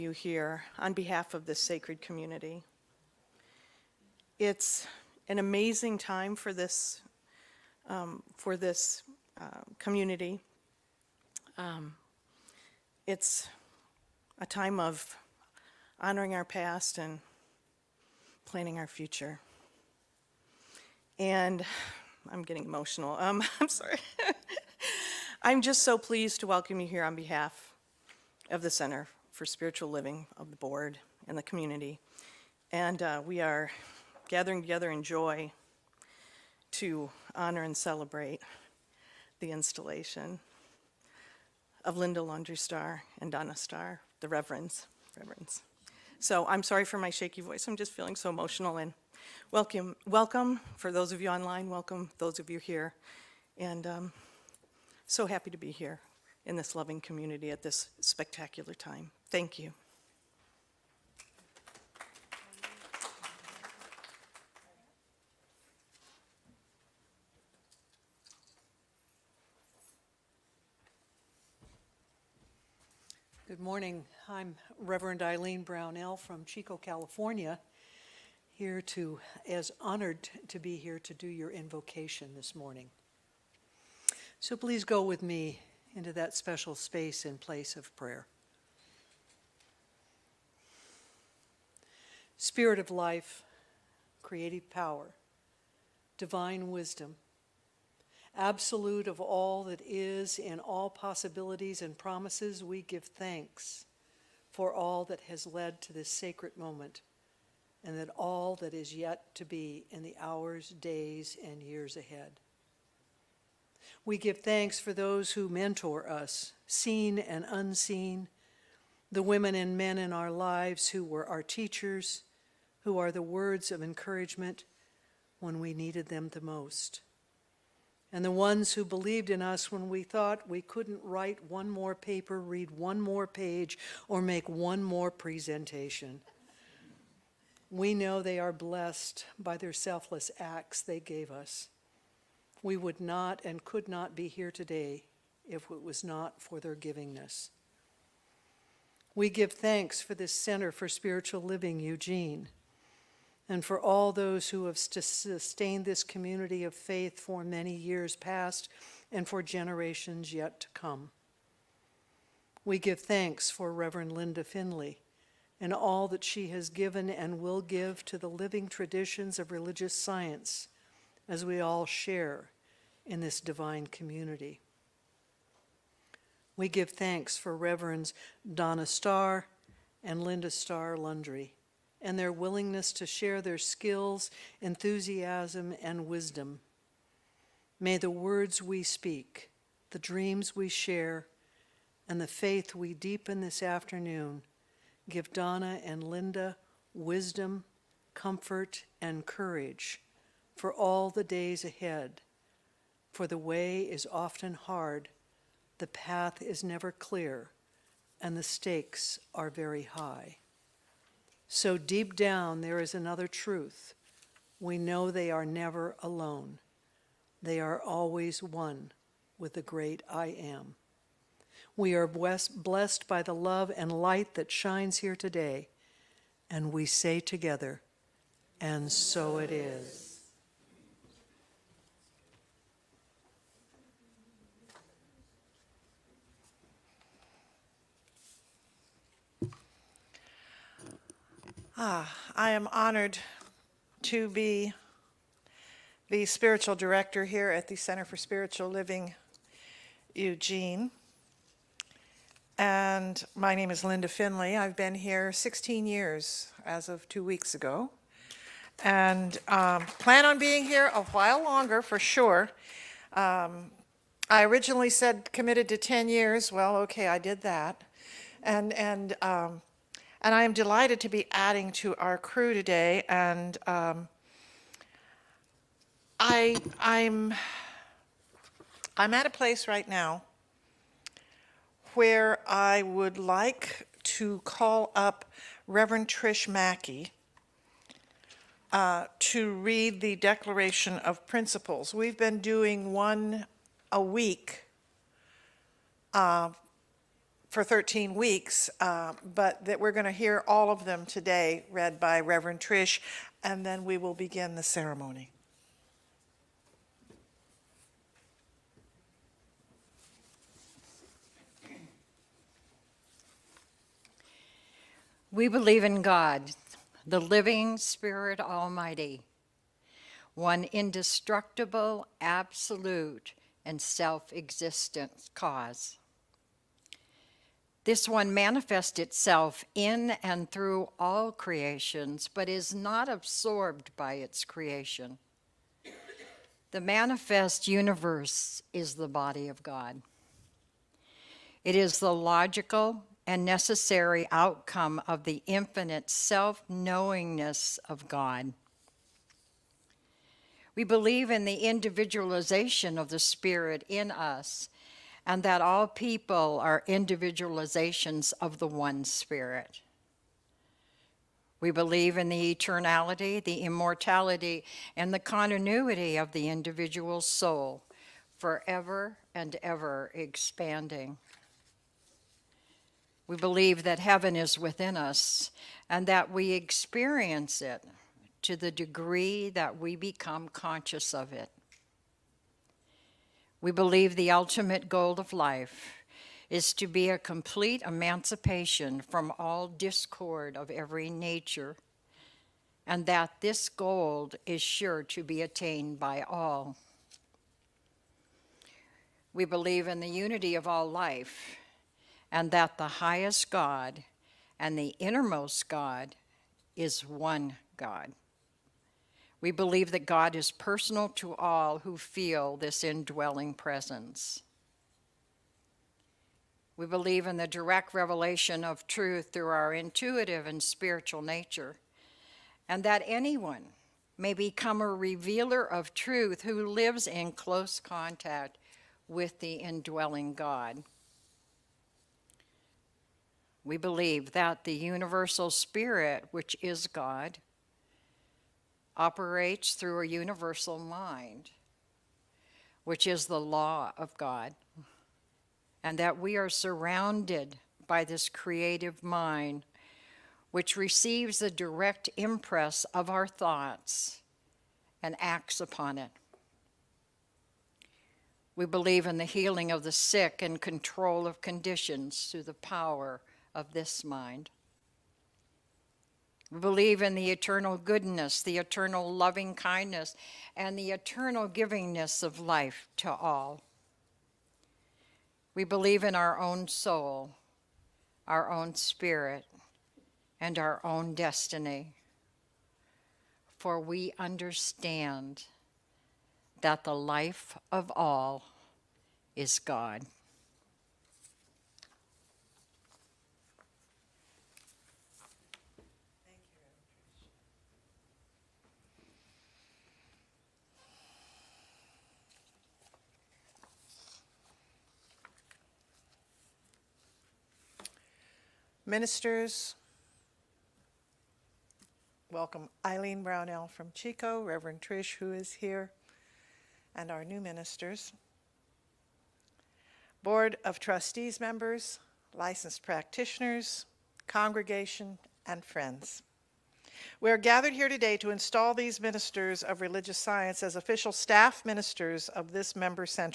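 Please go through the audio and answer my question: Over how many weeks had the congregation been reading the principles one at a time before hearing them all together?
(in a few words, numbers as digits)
13.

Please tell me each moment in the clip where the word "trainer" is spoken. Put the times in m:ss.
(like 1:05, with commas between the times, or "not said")
not said.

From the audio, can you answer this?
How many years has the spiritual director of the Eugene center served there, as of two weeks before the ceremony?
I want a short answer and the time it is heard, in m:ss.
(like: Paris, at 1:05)
16, at 4:15.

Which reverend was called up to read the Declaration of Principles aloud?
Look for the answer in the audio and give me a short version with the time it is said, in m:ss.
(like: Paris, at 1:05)
Trish Mackey, at 4:46.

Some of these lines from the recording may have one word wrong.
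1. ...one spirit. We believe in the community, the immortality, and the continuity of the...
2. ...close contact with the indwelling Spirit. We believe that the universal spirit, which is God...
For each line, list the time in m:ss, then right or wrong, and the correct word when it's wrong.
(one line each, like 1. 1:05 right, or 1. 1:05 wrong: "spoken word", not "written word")
1. 5:58 wrong: "eternality", not "community"
2. 7:07 wrong: "God", not "Spirit".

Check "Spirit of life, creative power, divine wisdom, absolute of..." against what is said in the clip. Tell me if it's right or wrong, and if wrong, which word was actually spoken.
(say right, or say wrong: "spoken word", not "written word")
right.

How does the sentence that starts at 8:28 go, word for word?
Ministers, welcome Eileen Brownell from Chico, Reverend Trish, who is here, and our new ministers.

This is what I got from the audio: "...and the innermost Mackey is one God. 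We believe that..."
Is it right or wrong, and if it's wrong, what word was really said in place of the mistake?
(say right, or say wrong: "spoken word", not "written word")
wrong: "God", not "Mackey".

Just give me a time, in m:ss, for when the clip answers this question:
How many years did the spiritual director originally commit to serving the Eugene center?
4:25.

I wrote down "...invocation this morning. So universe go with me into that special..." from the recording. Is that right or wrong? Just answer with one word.
wrong.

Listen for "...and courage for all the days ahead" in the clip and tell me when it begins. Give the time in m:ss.
3:19.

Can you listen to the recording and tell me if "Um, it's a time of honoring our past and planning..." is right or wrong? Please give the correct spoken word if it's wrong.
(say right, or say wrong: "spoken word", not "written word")
right.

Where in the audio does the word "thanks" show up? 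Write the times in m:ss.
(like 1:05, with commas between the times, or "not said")
0:59, 1:43, 1:54, 2:29, 2:43, 2:56.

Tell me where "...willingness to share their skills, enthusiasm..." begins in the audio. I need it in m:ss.
3:02.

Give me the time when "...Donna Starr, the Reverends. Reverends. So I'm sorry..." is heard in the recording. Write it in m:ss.
0:43.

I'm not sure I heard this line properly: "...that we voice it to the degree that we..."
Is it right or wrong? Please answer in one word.
wrong.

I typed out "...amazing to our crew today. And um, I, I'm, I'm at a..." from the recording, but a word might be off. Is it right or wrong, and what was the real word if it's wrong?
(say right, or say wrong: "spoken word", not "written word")
wrong: "adding", not "amazing".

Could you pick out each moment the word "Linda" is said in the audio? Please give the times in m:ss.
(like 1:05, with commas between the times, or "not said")
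0:41, 2:44, 3:00, 3:16, 4:13.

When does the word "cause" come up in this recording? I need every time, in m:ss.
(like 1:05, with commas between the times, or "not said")
5:25.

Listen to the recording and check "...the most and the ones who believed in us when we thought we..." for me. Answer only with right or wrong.
right.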